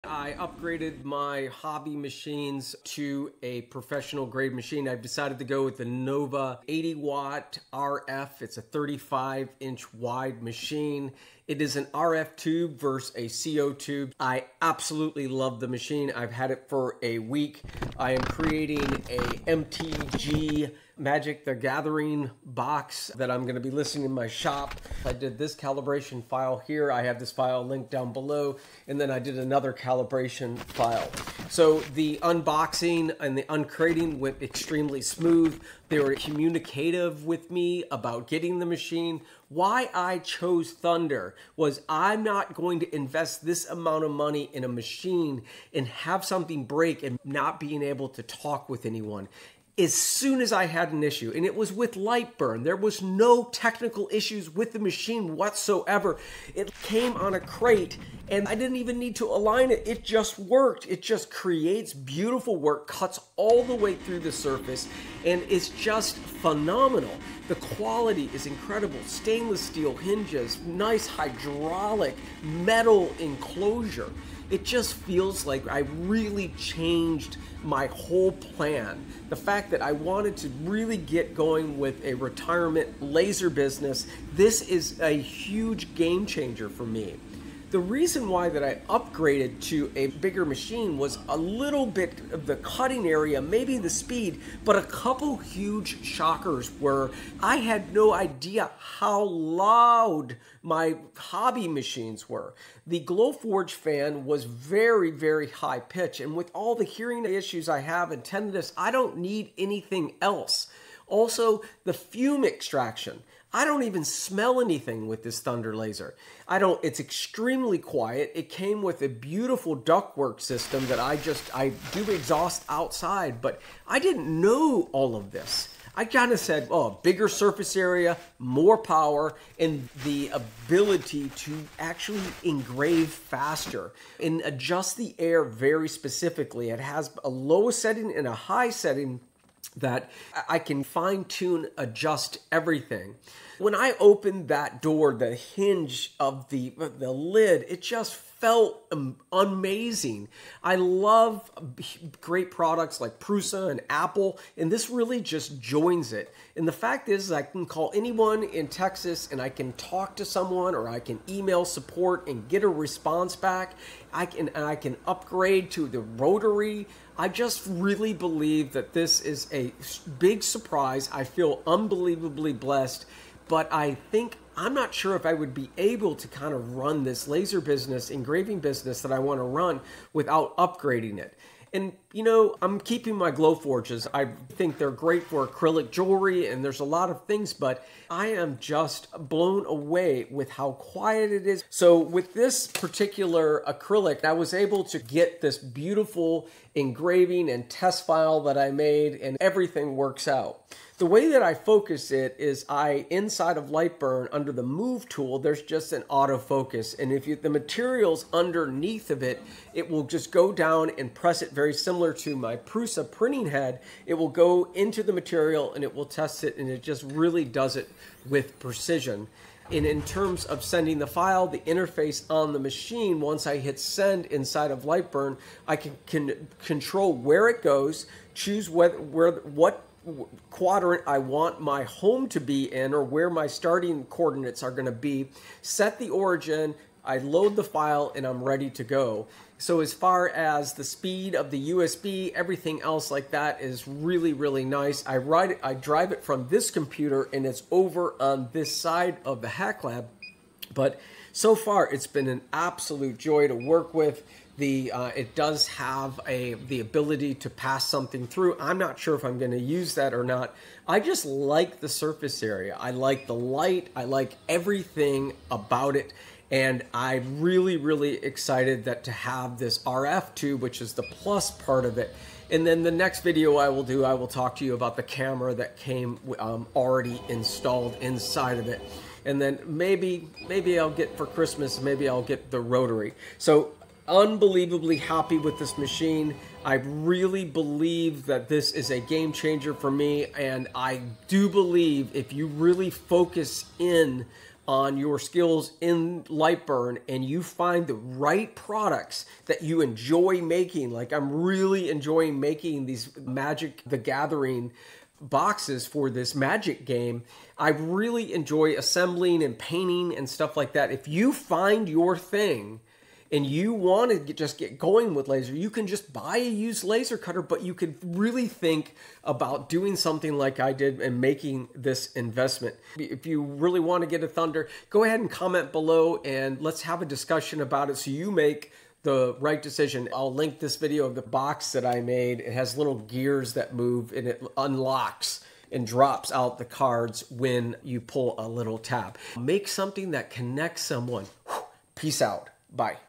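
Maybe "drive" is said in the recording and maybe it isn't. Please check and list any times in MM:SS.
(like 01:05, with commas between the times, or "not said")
04:05.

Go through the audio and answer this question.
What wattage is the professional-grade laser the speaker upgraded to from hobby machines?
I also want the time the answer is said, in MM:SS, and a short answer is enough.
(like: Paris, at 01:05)
80 watt, at 00:06.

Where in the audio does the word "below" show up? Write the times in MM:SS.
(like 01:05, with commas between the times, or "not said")
00:28, 05:25.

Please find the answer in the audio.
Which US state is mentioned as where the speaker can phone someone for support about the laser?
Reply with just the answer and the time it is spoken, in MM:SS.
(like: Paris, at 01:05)
Texas, at 02:38.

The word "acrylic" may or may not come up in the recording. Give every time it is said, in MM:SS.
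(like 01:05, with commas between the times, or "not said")
03:05, 03:13.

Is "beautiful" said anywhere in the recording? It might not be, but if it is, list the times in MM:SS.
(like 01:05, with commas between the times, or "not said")
01:01, 01:59, 03:15.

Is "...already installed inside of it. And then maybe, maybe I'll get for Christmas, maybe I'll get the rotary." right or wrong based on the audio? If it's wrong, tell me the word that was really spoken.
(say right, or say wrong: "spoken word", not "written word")
right.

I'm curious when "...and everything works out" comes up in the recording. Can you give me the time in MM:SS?
03:19.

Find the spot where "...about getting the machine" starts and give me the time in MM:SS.
00:37.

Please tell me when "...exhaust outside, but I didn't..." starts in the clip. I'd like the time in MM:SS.
02:02.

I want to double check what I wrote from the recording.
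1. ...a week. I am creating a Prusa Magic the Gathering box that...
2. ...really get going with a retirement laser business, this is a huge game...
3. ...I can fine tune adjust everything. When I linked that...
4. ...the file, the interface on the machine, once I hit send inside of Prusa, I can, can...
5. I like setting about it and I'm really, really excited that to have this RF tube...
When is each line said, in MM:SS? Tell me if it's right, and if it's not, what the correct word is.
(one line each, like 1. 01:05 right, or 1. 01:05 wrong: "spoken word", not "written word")
1. 00:17 wrong: "MTG", not "Prusa"
2. 01:20 right
3. 02:20 wrong: "opened", not "linked"
4. 03:40 wrong: "Lightburn", not "Prusa"
5. 04:23 wrong: "everything", not "setting".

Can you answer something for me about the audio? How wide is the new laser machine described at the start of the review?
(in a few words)
35 inch.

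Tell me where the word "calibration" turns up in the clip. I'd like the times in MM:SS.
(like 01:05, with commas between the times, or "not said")
00:25, 00:29.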